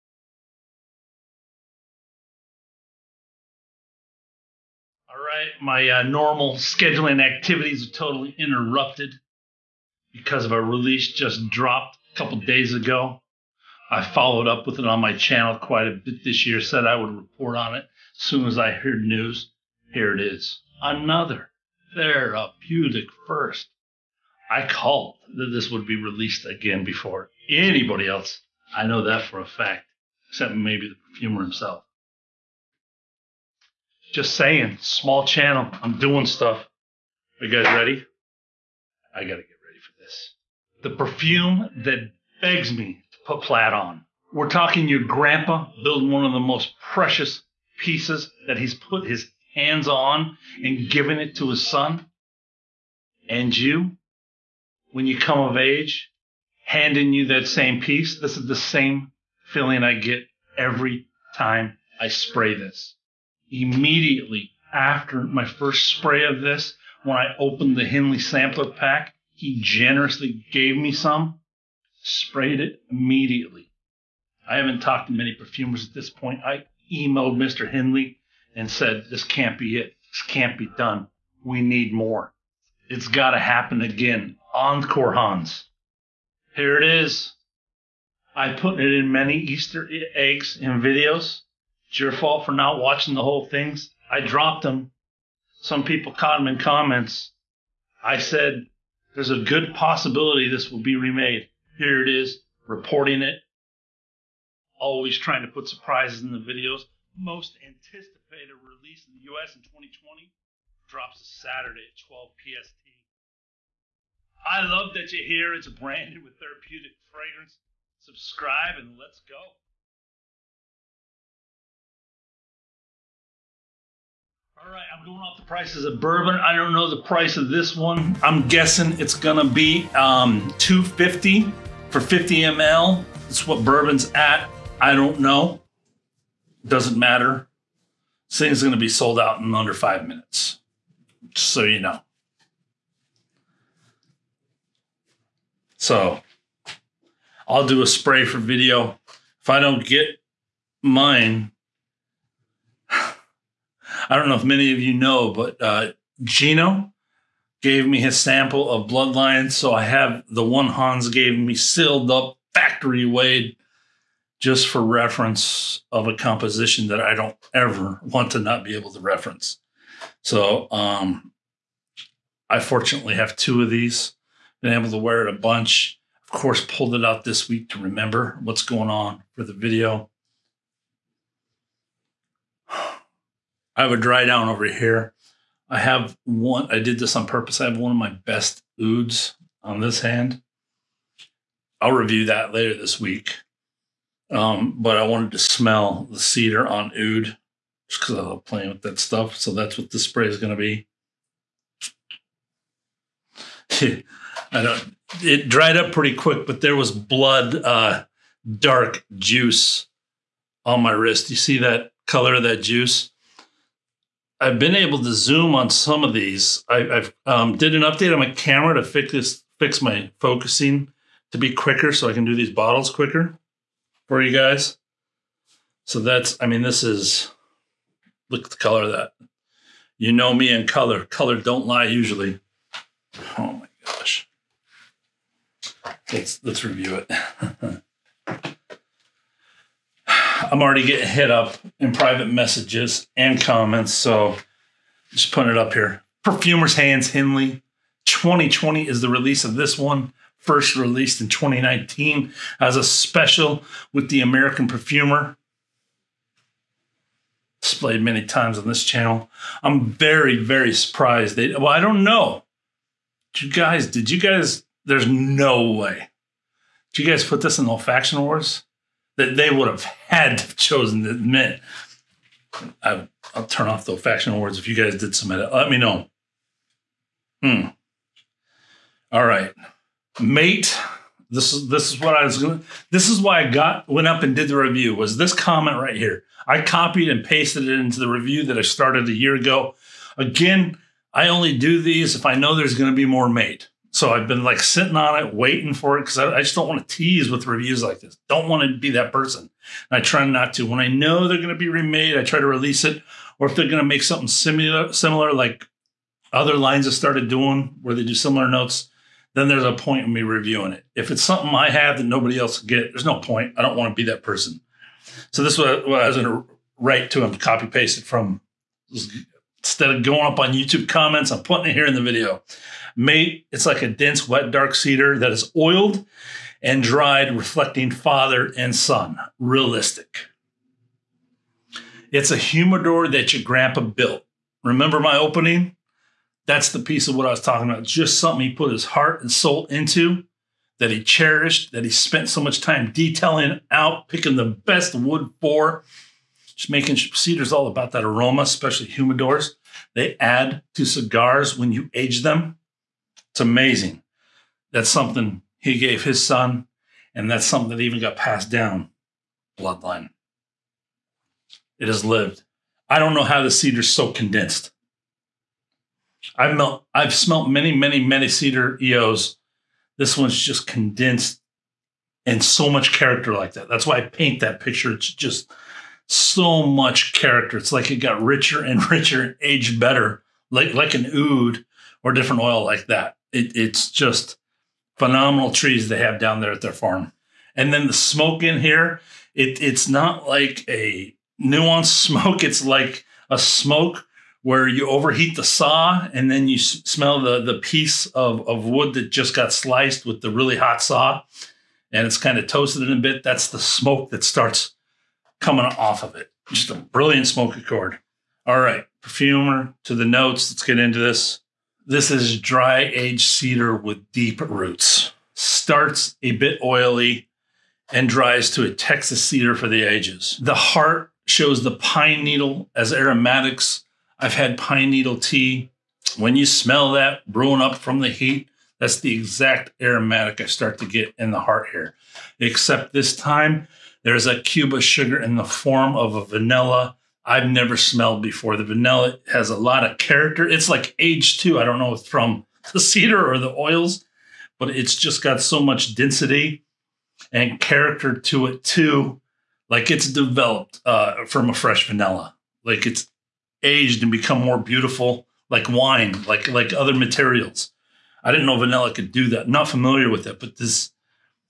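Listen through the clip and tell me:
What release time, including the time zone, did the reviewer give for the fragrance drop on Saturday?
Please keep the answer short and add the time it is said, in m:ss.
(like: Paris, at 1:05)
12 PST, at 1:52.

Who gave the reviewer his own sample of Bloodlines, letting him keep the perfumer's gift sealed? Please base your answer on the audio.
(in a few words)
Gino.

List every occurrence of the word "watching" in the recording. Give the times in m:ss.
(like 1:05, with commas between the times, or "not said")
1:32.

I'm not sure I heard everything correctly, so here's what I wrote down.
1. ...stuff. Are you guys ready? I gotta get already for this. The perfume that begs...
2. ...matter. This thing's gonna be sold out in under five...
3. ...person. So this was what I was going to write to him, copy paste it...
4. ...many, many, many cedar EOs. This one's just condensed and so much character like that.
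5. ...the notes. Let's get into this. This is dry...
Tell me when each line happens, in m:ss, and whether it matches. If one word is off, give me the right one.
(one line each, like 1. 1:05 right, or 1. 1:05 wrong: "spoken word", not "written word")
1. 0:36 wrong: "ready", not "already"
2. 2:16 right
3. 5:14 right
4. 6:07 right
5. 6:49 right.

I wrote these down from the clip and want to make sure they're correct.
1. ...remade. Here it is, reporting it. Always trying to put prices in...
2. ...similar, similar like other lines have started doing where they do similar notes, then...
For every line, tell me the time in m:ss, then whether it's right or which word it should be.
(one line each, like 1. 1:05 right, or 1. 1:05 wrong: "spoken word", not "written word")
1. 1:40 wrong: "surprises", not "prices"
2. 5:04 right.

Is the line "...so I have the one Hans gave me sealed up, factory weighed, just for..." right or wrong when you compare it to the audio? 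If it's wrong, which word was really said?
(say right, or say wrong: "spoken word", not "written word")
right.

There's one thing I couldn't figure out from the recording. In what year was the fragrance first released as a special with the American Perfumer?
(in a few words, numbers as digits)
2019.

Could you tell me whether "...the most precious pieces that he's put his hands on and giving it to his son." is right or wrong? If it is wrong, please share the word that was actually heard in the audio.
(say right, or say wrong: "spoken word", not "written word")
right.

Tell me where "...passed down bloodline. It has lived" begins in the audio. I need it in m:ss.
5:58.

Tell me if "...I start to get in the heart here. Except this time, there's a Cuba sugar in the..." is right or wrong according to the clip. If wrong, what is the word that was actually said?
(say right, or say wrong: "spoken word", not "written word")
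right.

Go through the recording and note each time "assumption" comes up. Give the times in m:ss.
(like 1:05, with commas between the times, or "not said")
not said.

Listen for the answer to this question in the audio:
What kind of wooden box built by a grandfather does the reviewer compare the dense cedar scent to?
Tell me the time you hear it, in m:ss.
5:32.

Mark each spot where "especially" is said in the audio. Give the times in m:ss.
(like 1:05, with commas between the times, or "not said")
5:48.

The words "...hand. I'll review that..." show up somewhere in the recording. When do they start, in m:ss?
3:10.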